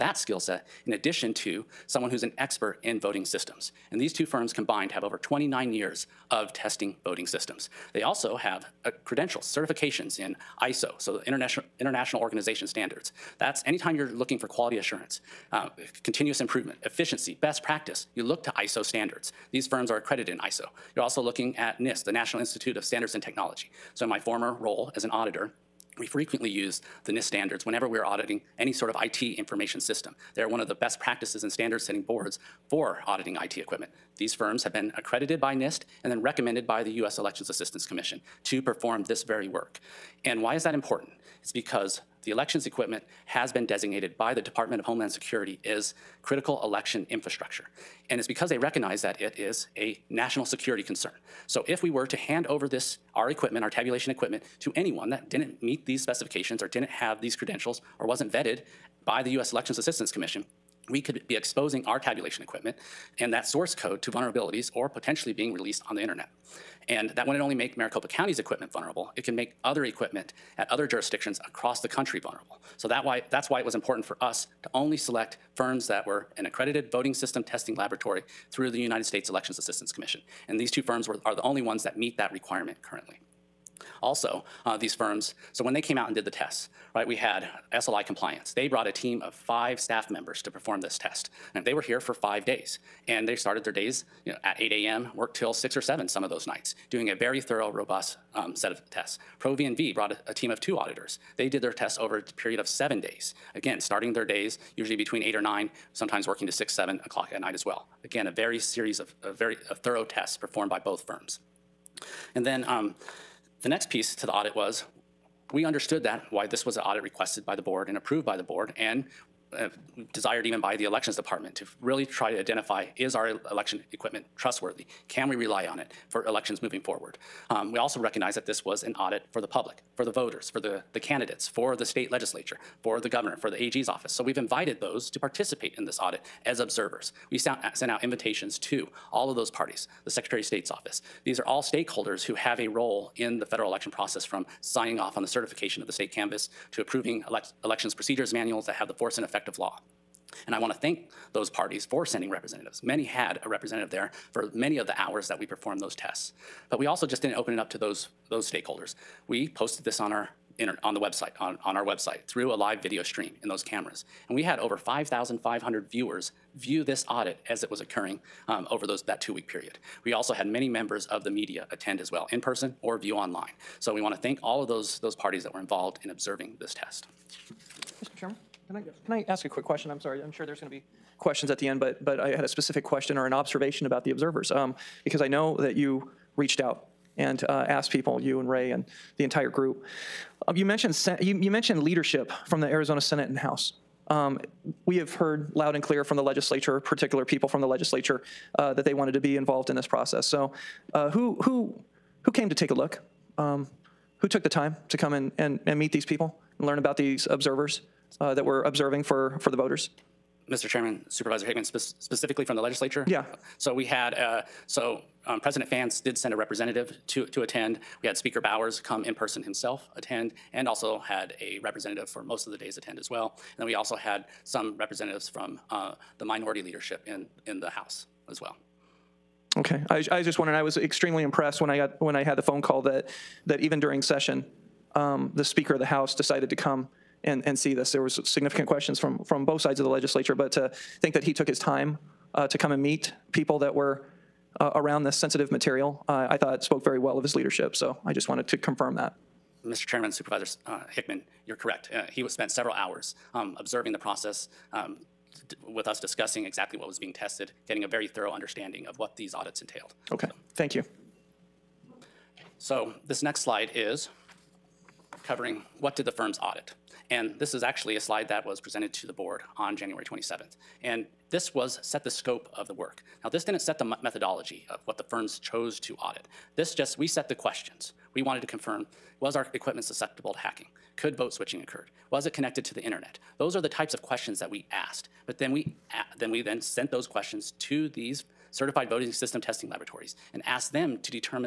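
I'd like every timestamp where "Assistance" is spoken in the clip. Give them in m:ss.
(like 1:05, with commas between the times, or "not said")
0:37, 0:59, 1:19.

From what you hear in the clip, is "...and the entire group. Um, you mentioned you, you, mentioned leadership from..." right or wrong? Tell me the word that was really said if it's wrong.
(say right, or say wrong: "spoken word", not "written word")
right.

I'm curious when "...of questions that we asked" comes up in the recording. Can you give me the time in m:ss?
4:43.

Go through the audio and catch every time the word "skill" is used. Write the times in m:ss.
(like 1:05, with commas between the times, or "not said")
0:00.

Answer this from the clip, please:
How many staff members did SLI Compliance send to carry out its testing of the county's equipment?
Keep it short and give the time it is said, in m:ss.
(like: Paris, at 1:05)
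5, at 1:29.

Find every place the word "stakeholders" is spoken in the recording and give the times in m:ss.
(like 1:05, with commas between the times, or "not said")
2:21, 2:38.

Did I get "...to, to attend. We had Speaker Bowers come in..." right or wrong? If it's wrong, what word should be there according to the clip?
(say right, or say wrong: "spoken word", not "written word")
right.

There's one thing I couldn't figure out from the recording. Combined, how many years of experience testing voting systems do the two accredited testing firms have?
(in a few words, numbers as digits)
29 years.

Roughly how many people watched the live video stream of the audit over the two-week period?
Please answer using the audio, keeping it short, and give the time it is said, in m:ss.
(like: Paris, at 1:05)
5,500, at 2:44.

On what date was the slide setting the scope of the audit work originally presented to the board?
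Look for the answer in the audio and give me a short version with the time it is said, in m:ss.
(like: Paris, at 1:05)
January 27th, at 4:29.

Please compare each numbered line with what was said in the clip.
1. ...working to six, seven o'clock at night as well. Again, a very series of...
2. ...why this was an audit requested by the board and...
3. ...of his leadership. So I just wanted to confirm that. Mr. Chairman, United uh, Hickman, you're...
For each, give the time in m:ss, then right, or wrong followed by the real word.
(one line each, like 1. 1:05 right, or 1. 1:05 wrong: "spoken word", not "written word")
1. 1:46 right
2. 1:56 right
3. 4:07 wrong: "Supervisor", not "United".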